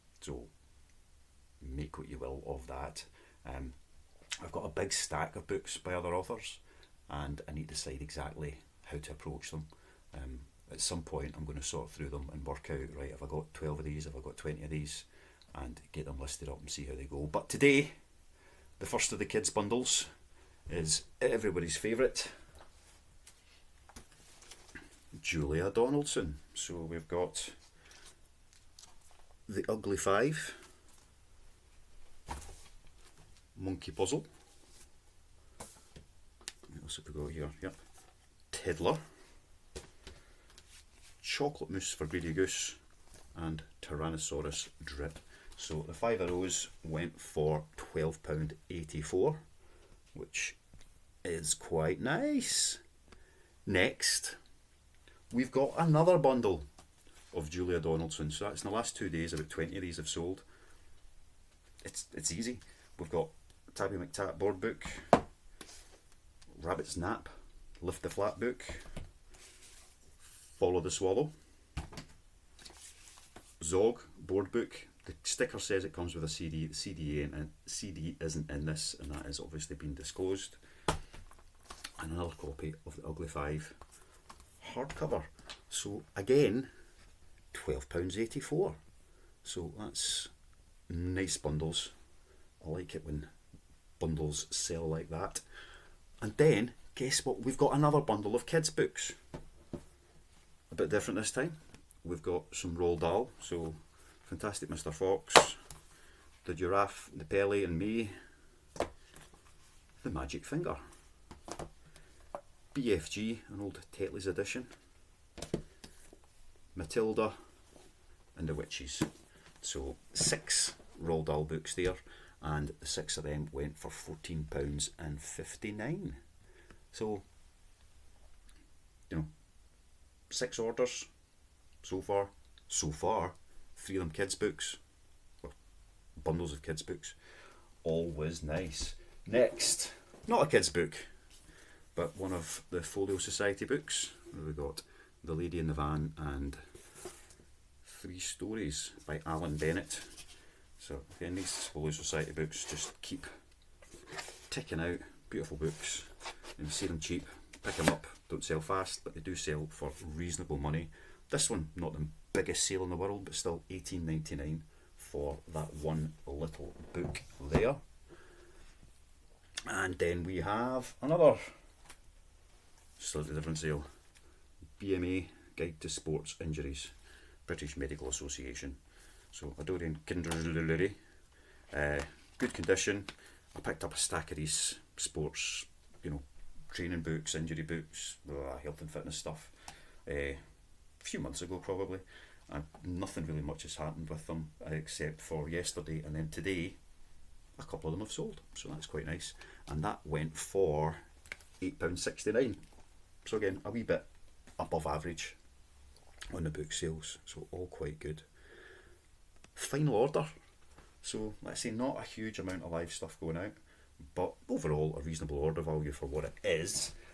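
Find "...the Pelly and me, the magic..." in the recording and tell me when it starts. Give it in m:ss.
1:47.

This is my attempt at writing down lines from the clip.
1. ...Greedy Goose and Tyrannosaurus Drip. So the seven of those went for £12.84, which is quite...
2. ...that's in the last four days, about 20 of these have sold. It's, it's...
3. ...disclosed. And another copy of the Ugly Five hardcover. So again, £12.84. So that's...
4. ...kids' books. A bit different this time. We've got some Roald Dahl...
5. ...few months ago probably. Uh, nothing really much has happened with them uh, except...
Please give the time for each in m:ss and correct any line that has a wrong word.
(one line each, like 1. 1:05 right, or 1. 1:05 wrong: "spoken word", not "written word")
1. 0:42 wrong: "five", not "seven"
2. 0:58 wrong: "two", not "four"
3. 1:19 right
4. 1:38 right
5. 3:11 right.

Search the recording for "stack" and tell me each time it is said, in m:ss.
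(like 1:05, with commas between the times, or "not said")
0:04, 3:03.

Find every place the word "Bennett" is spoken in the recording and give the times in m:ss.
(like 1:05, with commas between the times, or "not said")
2:29.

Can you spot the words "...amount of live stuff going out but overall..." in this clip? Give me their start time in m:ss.
3:32.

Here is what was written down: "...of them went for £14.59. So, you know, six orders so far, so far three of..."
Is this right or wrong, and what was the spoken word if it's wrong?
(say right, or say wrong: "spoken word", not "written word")
right.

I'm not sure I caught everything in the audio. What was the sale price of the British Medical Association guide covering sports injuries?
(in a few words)
£8.69.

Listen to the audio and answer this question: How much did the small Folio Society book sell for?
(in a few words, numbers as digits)
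£18.99.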